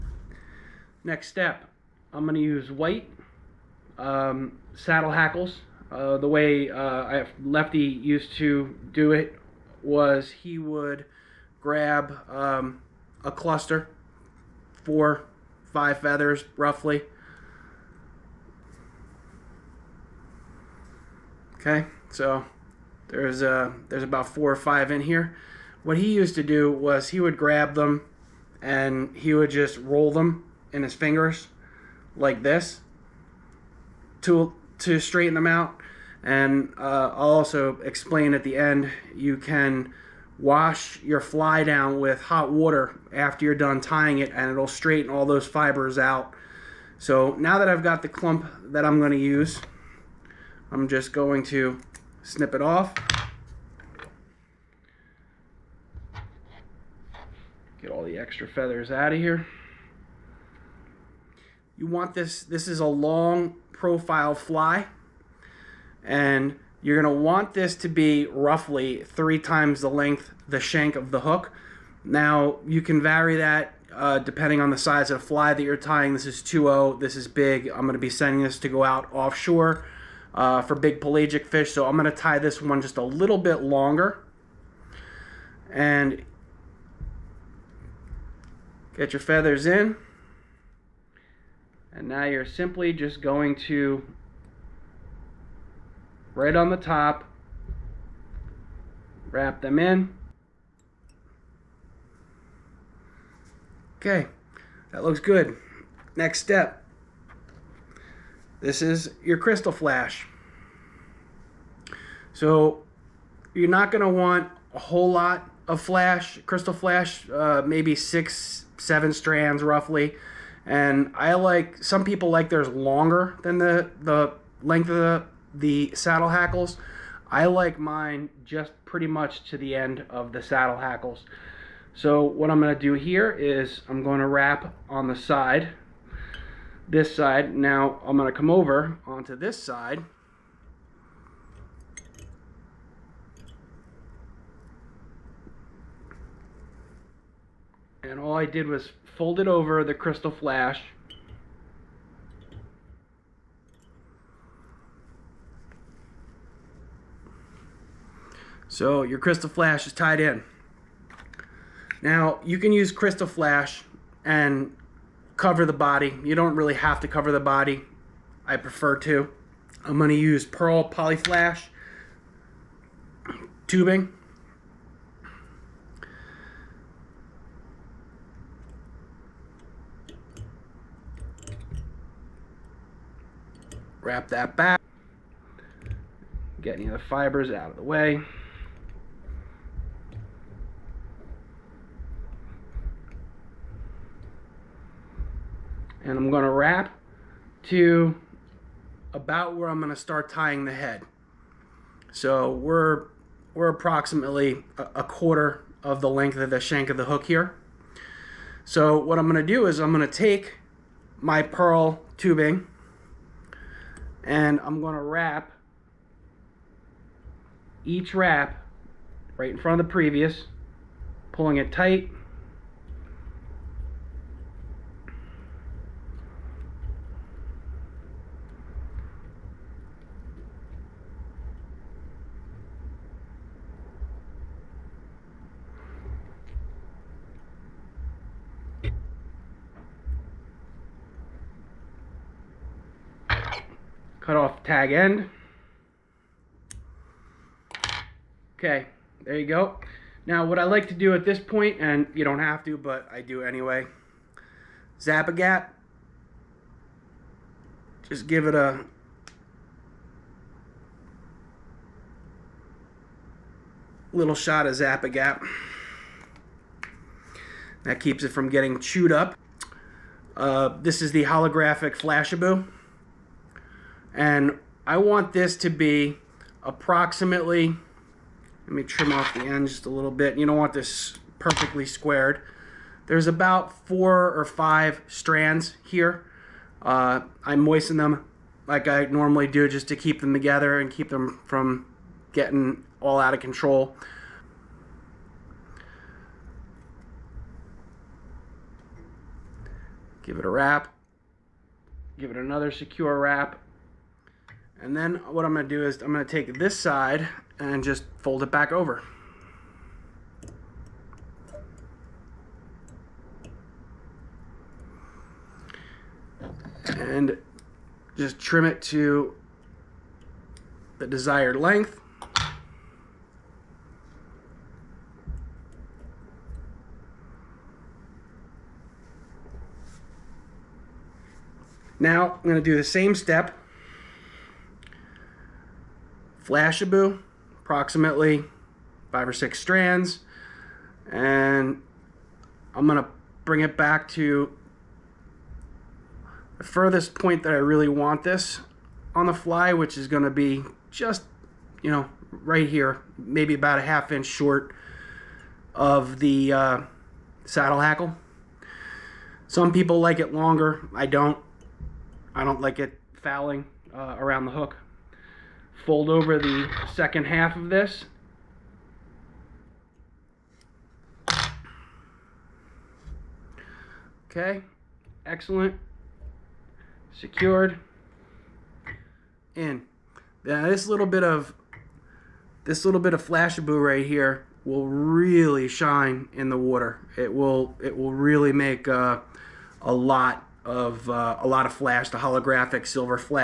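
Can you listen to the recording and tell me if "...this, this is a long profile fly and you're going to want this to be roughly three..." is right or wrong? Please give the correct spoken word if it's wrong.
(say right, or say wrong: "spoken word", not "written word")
right.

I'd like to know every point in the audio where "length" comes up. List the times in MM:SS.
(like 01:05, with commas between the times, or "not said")
01:09, 02:04, 03:26, 05:21.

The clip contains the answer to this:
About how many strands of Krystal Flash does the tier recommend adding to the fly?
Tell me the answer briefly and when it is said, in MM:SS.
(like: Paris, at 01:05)
6 or 7, at 01:57.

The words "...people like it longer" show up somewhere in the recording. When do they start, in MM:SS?
05:59.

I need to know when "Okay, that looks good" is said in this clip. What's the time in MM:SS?
01:43.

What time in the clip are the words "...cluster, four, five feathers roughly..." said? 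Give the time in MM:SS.
00:13.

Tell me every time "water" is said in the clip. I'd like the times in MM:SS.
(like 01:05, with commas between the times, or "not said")
00:42, 06:26.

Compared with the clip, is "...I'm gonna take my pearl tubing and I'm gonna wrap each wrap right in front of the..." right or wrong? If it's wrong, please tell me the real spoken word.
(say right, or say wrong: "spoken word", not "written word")
right.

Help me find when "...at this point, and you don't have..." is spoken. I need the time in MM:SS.
04:11.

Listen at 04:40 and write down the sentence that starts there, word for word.
You don't want this perfectly squared.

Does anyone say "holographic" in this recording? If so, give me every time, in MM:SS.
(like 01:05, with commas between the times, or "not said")
04:31, 06:32.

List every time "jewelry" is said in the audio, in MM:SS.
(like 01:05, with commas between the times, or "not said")
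not said.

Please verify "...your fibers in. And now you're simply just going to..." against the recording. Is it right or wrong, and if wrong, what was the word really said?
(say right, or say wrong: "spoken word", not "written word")
wrong: "feathers", not "fibers".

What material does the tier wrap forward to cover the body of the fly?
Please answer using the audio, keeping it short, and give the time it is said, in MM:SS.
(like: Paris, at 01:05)
Pearl Polyflash tubing, at 02:50.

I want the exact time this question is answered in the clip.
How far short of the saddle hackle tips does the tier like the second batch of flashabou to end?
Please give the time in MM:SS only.
05:53.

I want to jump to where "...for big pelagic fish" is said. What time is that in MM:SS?
01:20.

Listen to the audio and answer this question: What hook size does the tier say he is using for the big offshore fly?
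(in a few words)
2.0.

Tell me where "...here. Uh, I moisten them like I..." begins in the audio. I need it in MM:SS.
04:45.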